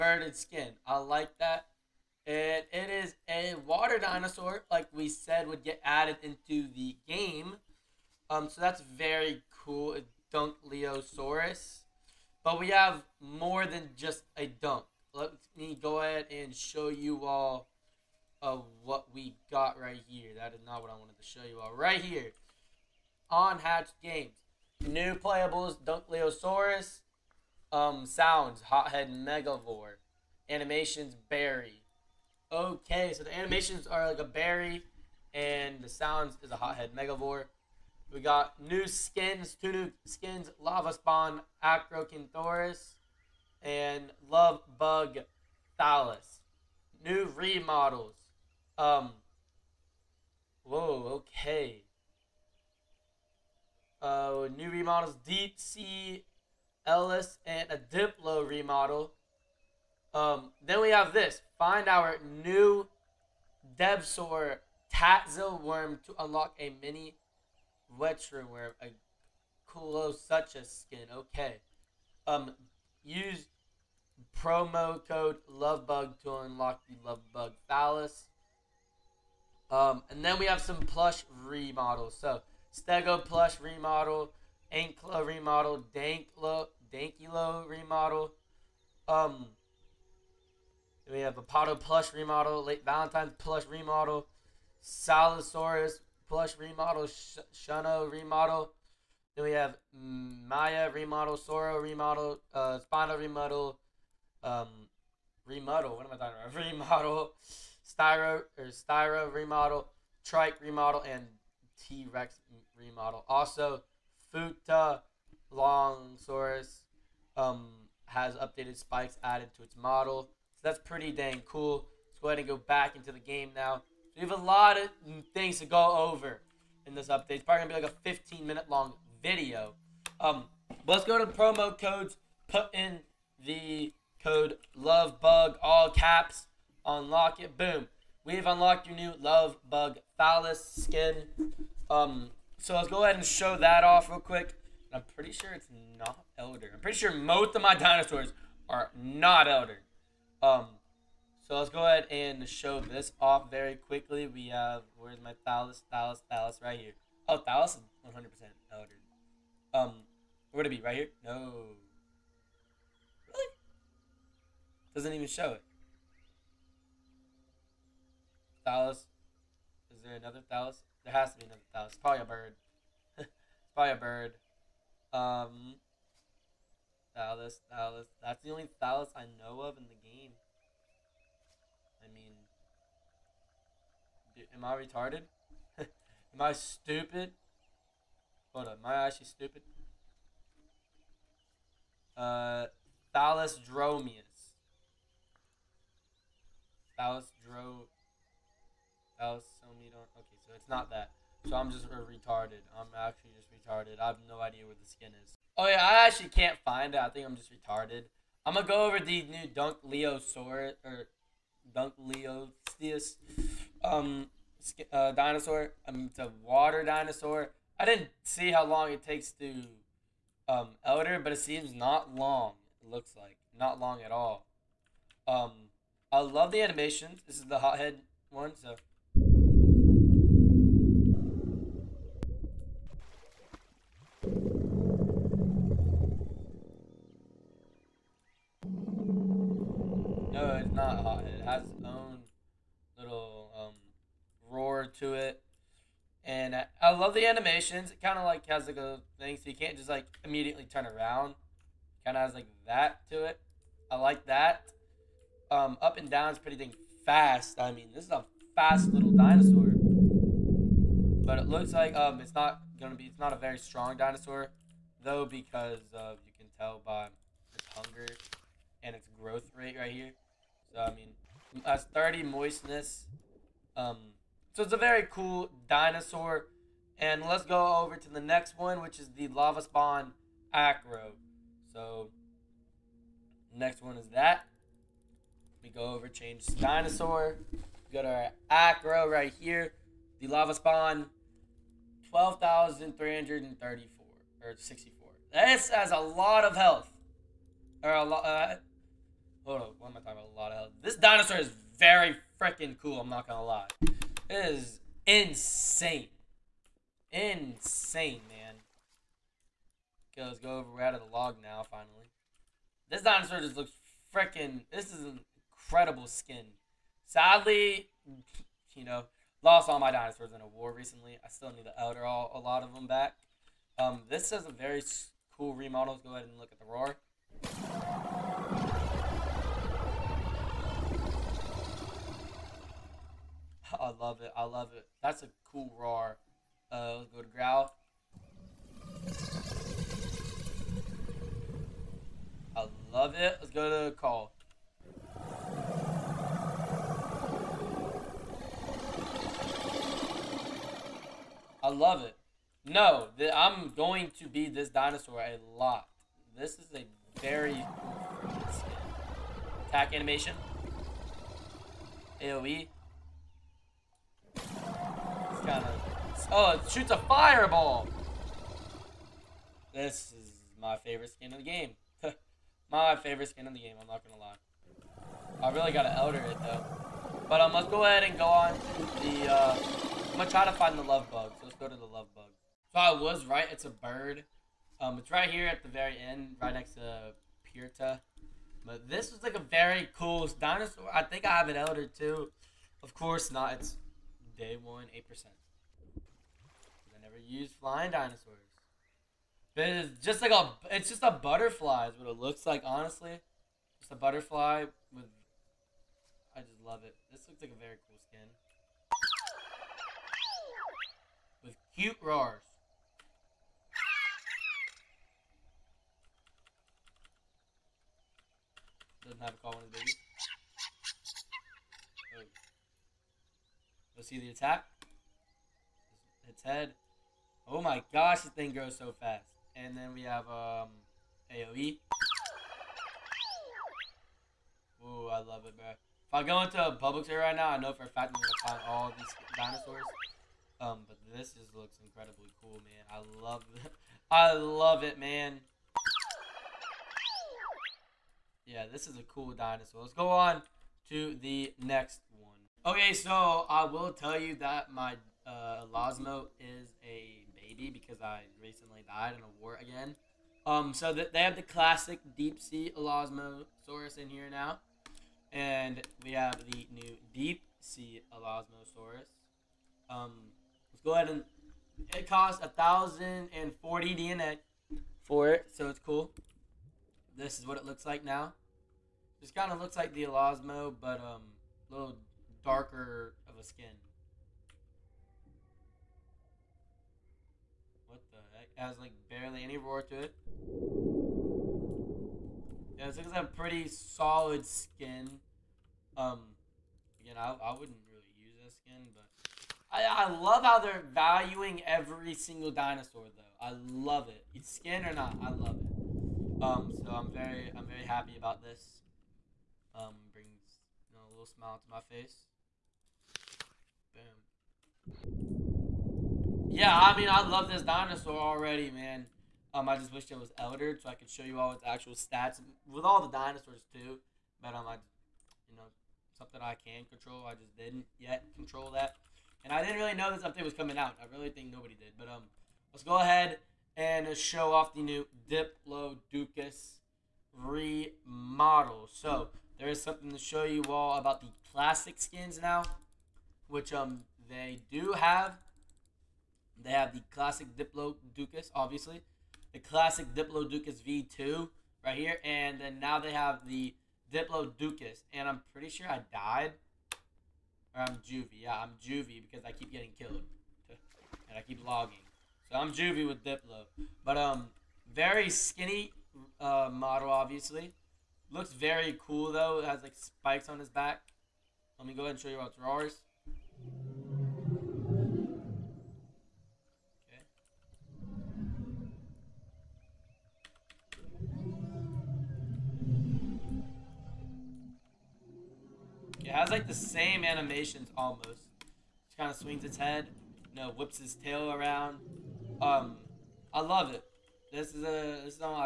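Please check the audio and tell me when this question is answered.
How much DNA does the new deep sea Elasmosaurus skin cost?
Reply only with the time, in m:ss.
7:52.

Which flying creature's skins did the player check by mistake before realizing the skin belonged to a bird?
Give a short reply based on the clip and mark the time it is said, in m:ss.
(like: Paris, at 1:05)
Thalassodromeus, at 3:13.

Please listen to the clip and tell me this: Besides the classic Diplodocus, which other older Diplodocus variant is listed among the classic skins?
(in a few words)
Diplodocus V2.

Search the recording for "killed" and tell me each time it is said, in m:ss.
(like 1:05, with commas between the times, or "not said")
9:19.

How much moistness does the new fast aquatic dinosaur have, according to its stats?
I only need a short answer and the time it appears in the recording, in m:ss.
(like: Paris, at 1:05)
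30, at 4:31.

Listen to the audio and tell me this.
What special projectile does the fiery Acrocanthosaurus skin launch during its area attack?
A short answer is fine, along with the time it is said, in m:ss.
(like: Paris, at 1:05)
a fireball, at 6:06.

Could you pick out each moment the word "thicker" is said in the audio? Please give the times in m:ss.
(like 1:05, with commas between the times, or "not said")
not said.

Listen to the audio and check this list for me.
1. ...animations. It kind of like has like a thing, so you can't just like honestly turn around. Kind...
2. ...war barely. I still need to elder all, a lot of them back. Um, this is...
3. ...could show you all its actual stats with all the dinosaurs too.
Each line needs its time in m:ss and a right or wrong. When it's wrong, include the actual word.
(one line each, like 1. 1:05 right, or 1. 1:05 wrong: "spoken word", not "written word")
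1. 4:07 wrong: "immediately", not "honestly"
2. 5:20 wrong: "recently", not "barely"
3. 8:40 right.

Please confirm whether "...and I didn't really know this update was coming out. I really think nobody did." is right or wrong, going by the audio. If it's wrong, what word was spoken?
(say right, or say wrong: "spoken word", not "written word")
right.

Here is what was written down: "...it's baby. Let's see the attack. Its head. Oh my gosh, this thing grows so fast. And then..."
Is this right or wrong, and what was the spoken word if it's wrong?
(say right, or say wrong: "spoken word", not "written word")
right.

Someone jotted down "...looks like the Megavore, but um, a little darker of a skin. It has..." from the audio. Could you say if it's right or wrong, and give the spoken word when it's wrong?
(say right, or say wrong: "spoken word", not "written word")
wrong: "Elasmo", not "Megavore".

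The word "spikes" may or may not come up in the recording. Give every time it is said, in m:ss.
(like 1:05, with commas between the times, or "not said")
1:58, 9:29.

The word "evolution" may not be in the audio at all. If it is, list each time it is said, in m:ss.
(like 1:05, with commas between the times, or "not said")
not said.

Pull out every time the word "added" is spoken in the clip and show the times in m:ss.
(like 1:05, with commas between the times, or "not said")
0:05, 1:59.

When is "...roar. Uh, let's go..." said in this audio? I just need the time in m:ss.
5:35.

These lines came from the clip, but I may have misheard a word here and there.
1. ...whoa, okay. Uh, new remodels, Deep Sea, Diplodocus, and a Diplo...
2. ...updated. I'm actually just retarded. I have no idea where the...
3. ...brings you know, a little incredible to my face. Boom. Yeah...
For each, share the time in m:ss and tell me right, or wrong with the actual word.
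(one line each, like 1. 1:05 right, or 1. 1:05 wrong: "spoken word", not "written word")
1. 0:50 wrong: "Ellis", not "Diplodocus"
2. 3:21 wrong: "retarded", not "updated"
3. 8:30 wrong: "smile", not "incredible".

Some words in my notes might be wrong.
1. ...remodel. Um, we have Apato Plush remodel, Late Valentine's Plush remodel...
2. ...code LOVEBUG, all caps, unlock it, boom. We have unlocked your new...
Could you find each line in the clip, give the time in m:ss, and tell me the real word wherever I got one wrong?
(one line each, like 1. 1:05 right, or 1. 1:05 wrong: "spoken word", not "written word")
1. 1:27 right
2. 2:14 right.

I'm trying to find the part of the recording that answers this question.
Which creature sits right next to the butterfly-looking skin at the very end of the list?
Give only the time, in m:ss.
6:27.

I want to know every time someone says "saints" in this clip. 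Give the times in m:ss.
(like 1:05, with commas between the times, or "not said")
not said.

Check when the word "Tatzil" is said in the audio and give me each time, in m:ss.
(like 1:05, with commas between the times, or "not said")
1:04.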